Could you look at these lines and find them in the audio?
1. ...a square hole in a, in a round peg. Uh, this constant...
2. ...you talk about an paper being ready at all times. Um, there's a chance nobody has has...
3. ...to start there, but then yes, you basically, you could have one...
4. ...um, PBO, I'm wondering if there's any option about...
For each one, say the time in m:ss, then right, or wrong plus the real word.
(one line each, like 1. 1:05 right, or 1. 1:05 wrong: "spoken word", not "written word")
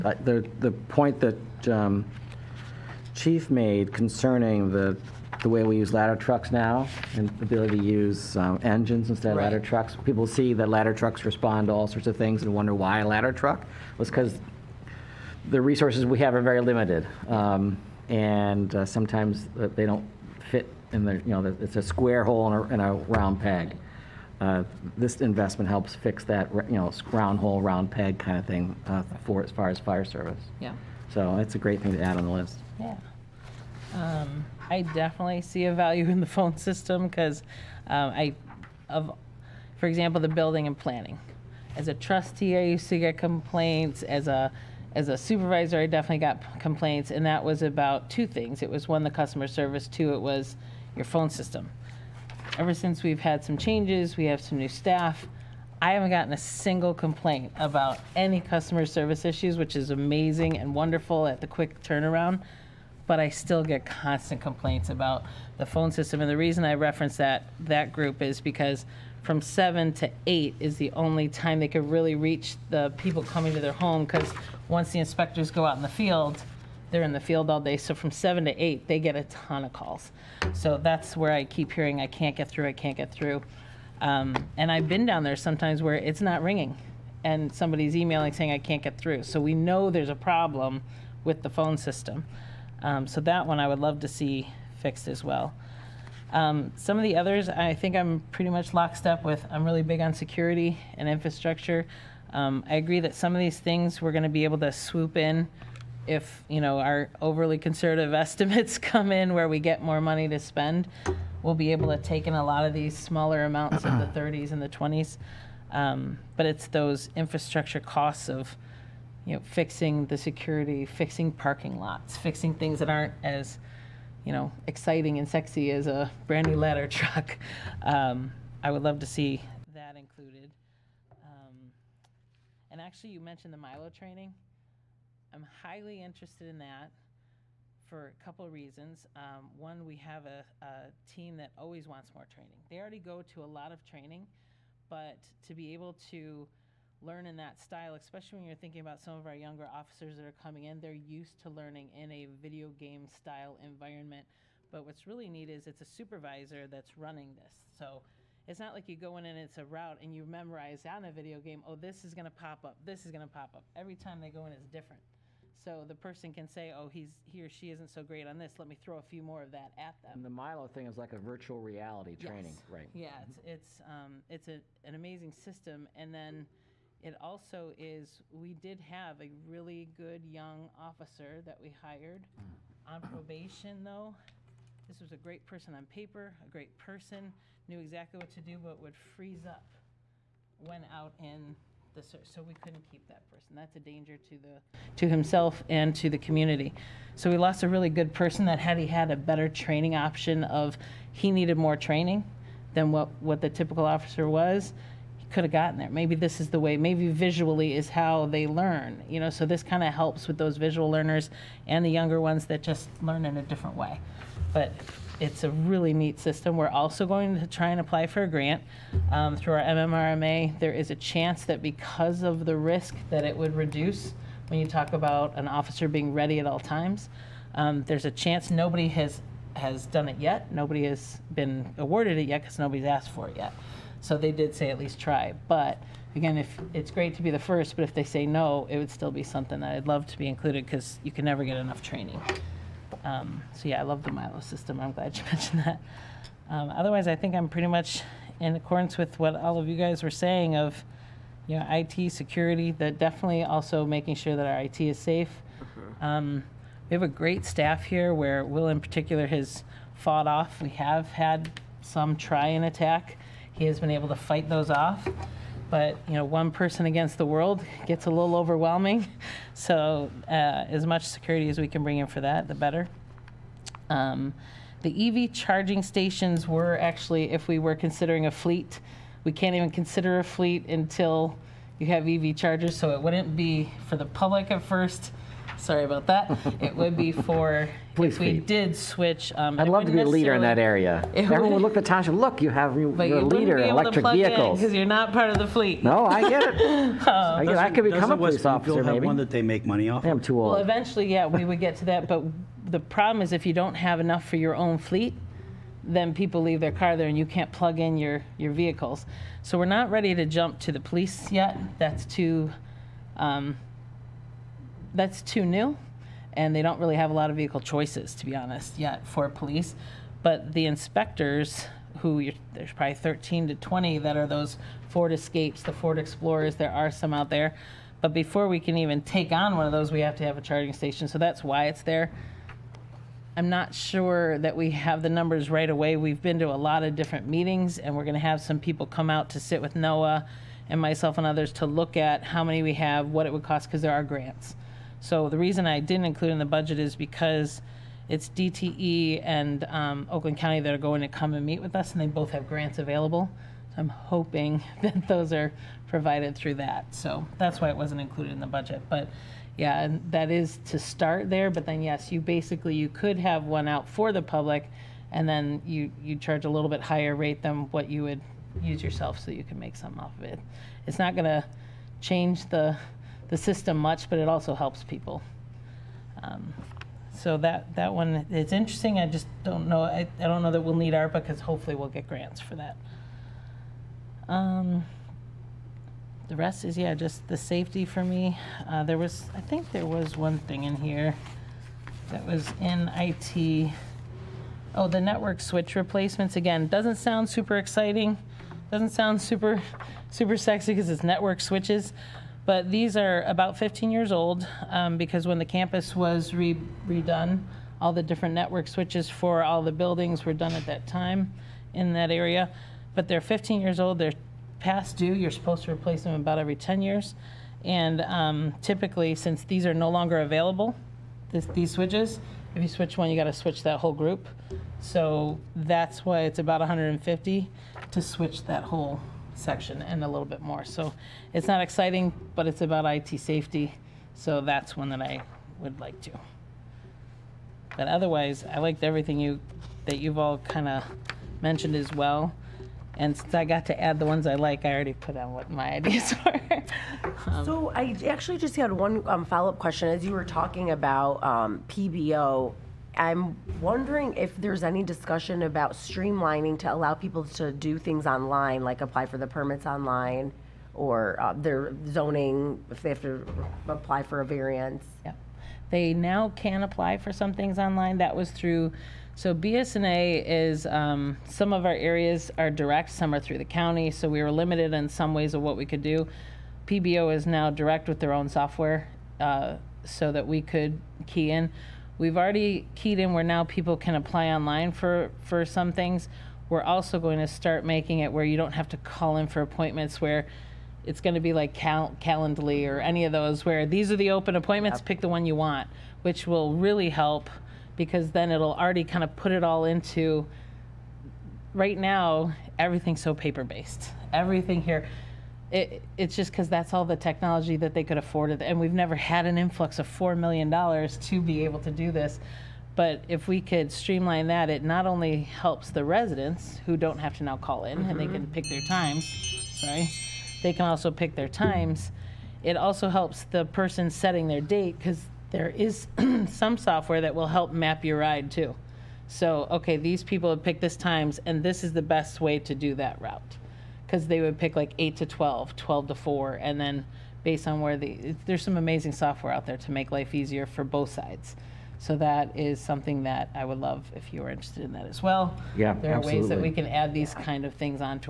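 1. 0:21 wrong: "investment", not "constant"
2. 3:44 wrong: "officer", not "paper"
3. 6:00 right
4. 7:31 wrong: "discussion", not "option".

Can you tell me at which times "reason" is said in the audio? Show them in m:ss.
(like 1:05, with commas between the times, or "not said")
1:06, 2:18, 5:45.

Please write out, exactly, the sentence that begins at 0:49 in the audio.
Two, it was your phone system ever since we've had some changes, we have some new staff.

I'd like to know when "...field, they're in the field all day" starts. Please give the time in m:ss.
1:15.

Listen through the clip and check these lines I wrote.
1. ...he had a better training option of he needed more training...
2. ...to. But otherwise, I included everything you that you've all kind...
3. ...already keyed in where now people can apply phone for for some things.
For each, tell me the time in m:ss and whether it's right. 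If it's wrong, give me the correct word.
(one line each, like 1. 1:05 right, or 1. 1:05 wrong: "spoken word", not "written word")
1. 3:18 right
2. 7:16 wrong: "liked", not "included"
3. 8:02 wrong: "online", not "phone".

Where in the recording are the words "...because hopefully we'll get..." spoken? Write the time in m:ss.
6:21.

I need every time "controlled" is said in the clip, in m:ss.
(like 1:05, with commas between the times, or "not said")
not said.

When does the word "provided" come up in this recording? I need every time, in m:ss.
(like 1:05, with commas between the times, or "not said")
5:55.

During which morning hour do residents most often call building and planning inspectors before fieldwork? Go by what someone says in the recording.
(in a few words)
7 to 8.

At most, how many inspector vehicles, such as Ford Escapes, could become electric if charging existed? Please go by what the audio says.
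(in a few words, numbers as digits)
20.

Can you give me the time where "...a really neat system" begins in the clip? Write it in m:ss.
3:35.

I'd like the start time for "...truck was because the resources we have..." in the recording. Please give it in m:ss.
0:13.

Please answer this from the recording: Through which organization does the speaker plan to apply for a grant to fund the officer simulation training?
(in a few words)
MMRMA.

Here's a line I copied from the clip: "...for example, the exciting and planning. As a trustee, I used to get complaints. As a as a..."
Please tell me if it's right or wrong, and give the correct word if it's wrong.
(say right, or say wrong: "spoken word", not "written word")
wrong: "building", not "exciting".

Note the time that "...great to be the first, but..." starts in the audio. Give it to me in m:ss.
3:56.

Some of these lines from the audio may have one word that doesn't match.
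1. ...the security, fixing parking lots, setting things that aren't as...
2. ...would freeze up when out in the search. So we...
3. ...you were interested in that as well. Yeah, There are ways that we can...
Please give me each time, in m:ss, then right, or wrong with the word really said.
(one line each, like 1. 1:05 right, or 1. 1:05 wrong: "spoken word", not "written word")
1. 2:00 wrong: "fixing", not "setting"
2. 3:08 right
3. 9:04 right.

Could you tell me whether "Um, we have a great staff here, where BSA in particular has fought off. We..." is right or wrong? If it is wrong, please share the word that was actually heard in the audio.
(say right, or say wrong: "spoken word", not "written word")
wrong: "Will", not "BSA".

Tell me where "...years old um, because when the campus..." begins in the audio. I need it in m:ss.
6:43.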